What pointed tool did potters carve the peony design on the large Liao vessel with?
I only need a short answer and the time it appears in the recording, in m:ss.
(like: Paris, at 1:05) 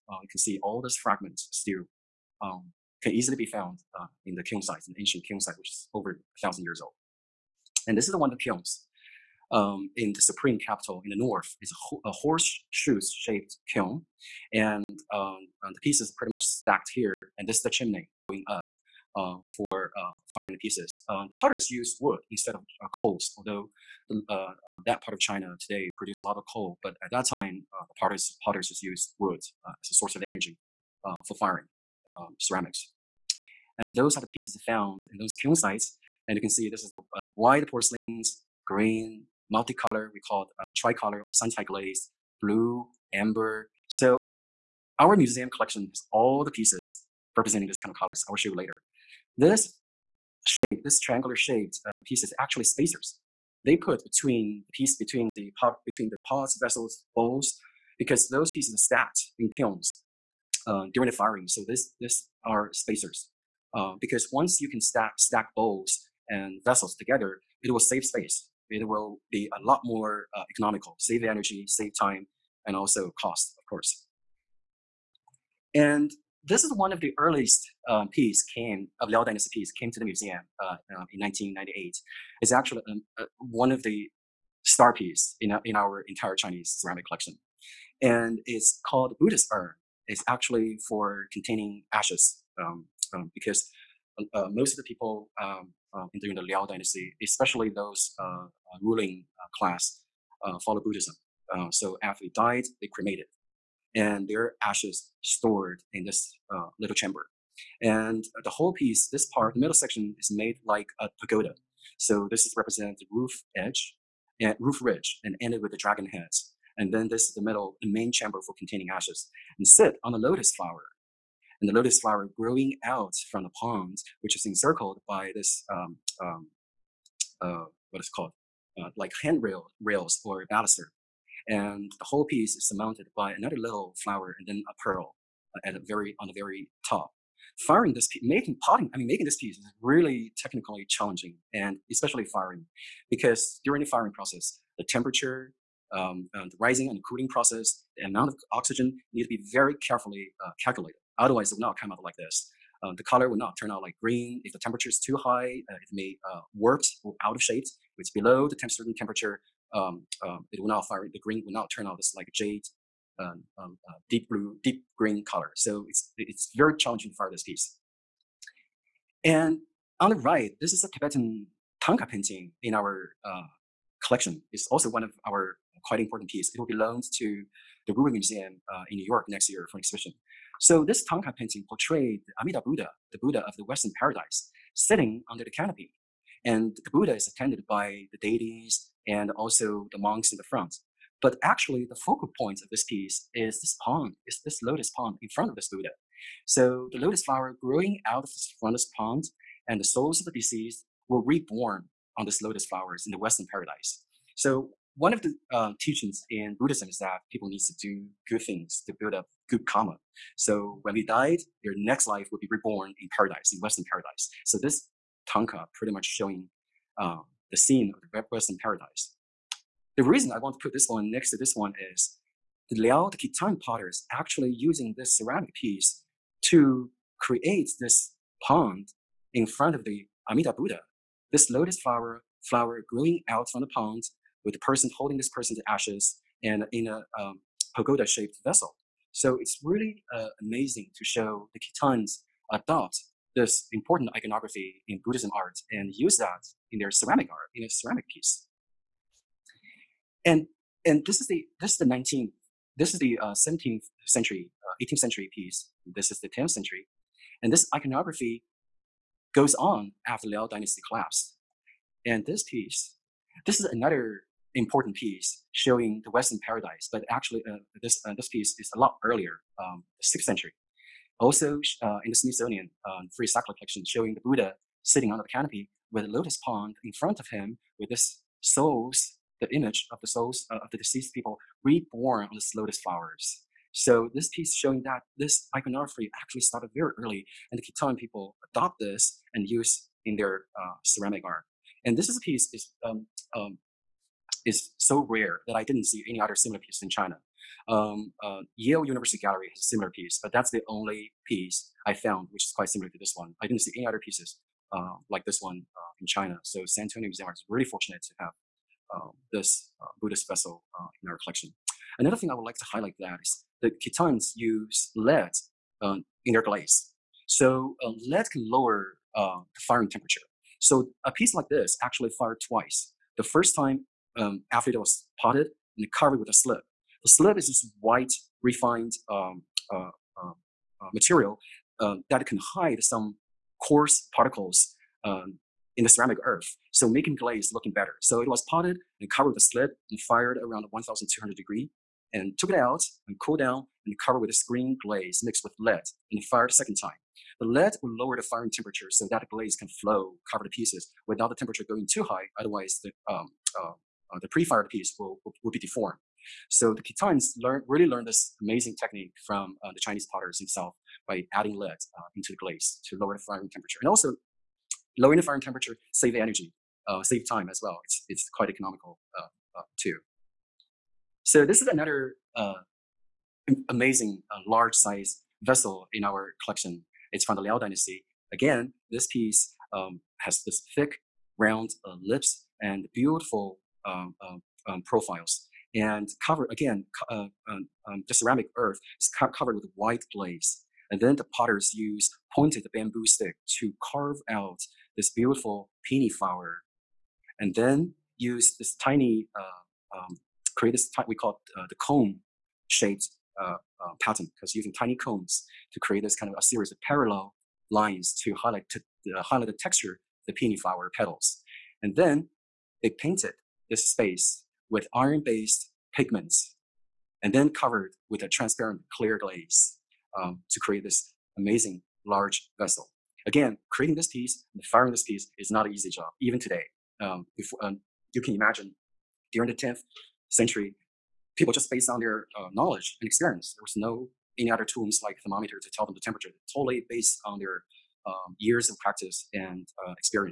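Bamboo stick, at 6:32.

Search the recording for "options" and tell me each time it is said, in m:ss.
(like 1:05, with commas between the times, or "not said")
not said.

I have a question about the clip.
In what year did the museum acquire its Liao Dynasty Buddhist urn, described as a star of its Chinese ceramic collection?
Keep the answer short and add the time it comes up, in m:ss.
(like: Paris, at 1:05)
1998, at 1:21.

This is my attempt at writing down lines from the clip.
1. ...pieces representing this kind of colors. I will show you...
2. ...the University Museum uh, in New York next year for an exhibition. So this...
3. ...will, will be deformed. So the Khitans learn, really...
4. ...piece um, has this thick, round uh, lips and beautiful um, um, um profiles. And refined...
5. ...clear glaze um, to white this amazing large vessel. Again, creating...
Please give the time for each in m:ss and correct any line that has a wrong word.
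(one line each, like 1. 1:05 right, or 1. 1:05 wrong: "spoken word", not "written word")
1. 0:46 right
2. 2:57 wrong: "Rubin", not "University"
3. 5:55 right
4. 6:19 wrong: "covered", not "refined"
5. 6:58 wrong: "create", not "white".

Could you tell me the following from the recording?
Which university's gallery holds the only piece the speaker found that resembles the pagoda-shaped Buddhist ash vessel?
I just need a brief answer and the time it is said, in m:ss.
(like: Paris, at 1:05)
Yale University, at 4:58.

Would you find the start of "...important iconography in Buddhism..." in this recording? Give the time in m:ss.
4:03.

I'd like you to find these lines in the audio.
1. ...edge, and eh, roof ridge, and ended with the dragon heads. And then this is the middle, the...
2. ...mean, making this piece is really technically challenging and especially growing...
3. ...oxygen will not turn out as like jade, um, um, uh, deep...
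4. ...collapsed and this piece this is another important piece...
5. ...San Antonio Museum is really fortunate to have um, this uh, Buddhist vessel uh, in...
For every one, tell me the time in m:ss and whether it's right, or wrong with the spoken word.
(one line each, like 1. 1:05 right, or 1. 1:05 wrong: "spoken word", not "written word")
1. 1:53 right
2. 2:18 wrong: "firing", not "growing"
3. 2:41 wrong: "green", not "oxygen"
4. 4:20 right
5. 5:06 right.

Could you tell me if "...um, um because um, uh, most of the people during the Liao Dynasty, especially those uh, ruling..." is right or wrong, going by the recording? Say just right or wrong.
right.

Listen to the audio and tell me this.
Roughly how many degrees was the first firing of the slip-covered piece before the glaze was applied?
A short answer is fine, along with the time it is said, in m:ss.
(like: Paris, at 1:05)
1,200, at 5:40.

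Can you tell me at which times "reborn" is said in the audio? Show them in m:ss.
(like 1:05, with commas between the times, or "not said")
3:21, 3:32, 4:41.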